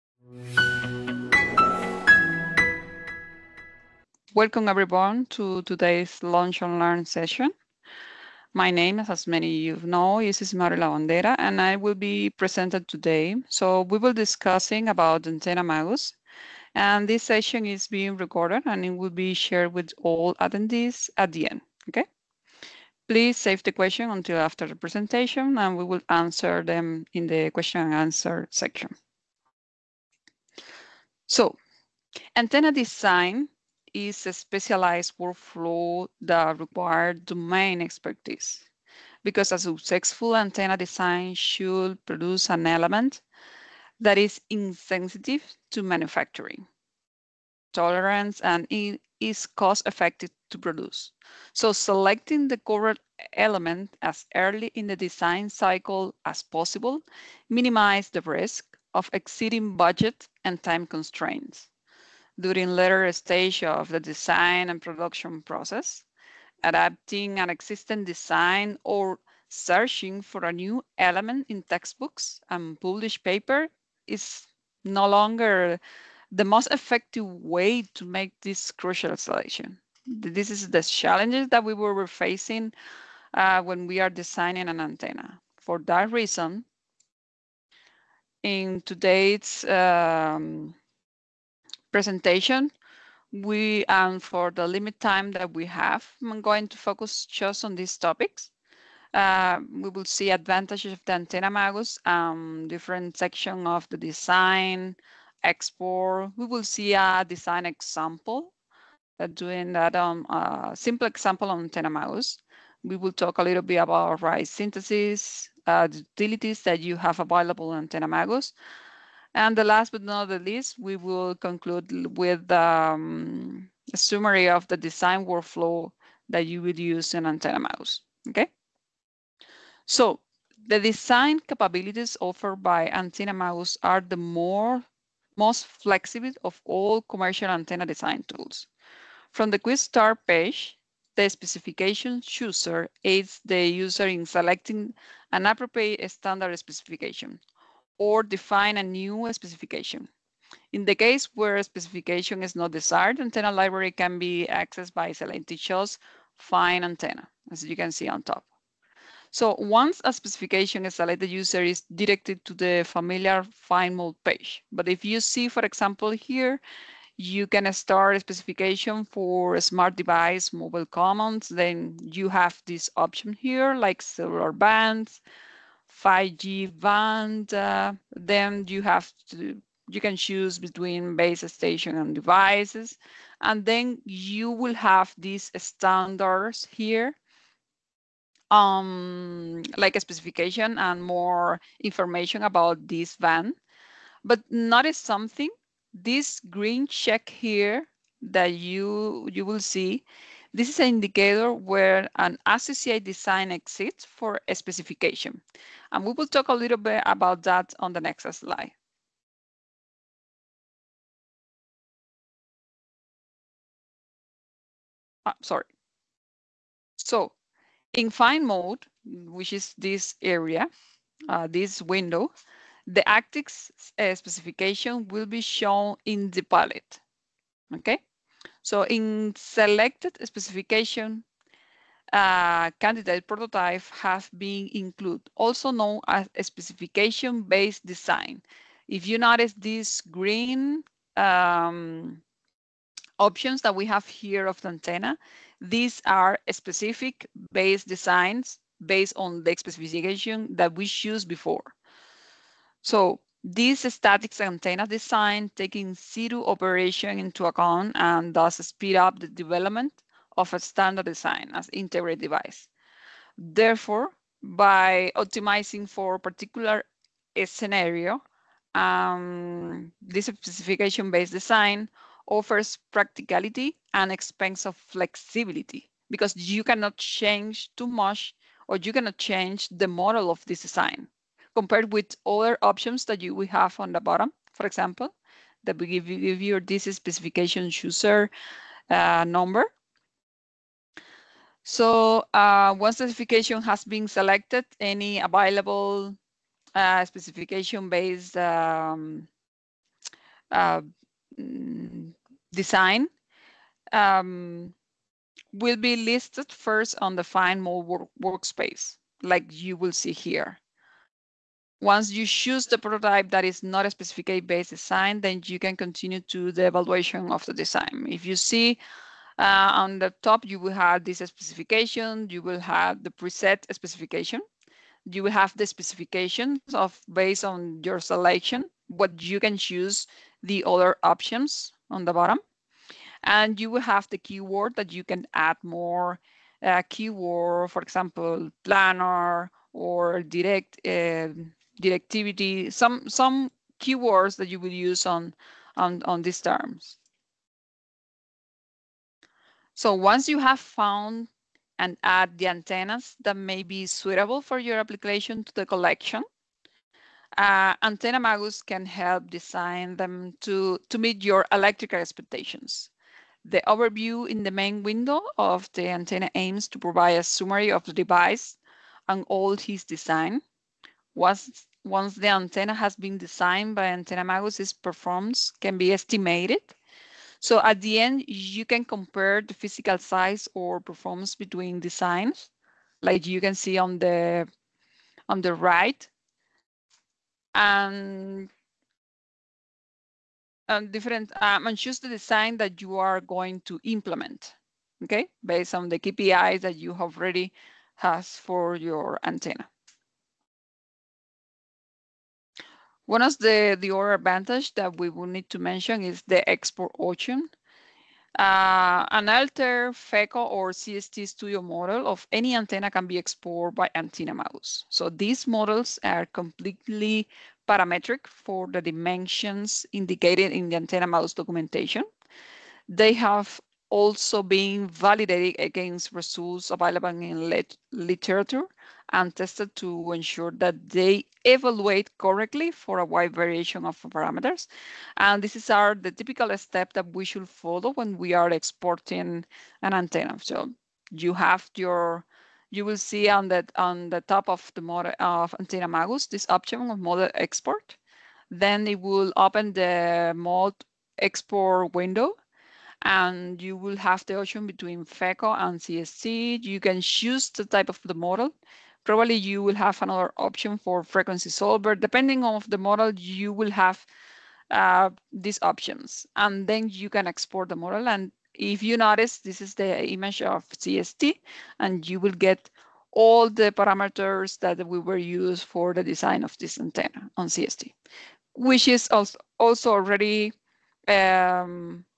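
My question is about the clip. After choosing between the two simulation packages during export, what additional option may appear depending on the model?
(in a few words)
Frequency solver.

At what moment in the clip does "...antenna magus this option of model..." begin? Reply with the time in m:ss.
7:25.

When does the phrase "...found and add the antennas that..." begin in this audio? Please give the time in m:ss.
5:50.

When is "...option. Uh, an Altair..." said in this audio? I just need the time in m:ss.
6:46.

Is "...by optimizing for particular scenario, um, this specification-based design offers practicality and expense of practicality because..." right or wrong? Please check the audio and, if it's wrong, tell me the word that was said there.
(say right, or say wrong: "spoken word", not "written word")
wrong: "flexibility", not "practicality".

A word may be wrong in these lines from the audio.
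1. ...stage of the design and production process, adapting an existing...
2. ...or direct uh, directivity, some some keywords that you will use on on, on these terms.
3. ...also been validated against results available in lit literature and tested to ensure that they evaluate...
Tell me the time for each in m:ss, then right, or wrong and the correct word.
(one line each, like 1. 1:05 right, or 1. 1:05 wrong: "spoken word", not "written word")
1. 1:03 right
2. 5:39 right
3. 7:03 right.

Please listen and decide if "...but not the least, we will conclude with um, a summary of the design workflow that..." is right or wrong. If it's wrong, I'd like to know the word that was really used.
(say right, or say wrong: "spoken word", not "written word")
right.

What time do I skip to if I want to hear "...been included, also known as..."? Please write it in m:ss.
3:54.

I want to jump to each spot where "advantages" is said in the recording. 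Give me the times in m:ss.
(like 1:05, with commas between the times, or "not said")
1:40, 6:44.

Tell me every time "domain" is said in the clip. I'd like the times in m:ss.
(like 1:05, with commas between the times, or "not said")
0:37.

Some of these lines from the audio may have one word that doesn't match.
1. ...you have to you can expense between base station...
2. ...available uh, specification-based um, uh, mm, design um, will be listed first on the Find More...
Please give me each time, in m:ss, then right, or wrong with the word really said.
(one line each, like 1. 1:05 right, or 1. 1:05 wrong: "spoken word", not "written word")
1. 2:58 wrong: "choose", not "expense"
2. 4:55 right.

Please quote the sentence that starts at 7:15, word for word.
And this is our the typical step that we should follow when we are exporting an antenna.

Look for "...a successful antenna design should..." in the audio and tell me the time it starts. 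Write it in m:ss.
0:39.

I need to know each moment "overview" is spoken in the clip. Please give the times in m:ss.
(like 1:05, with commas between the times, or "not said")
6:03.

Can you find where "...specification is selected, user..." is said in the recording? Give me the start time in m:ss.
2:40.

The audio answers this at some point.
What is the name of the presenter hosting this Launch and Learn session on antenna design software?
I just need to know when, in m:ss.
0:10.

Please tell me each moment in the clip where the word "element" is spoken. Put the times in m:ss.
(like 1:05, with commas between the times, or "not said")
0:42, 0:53, 1:10.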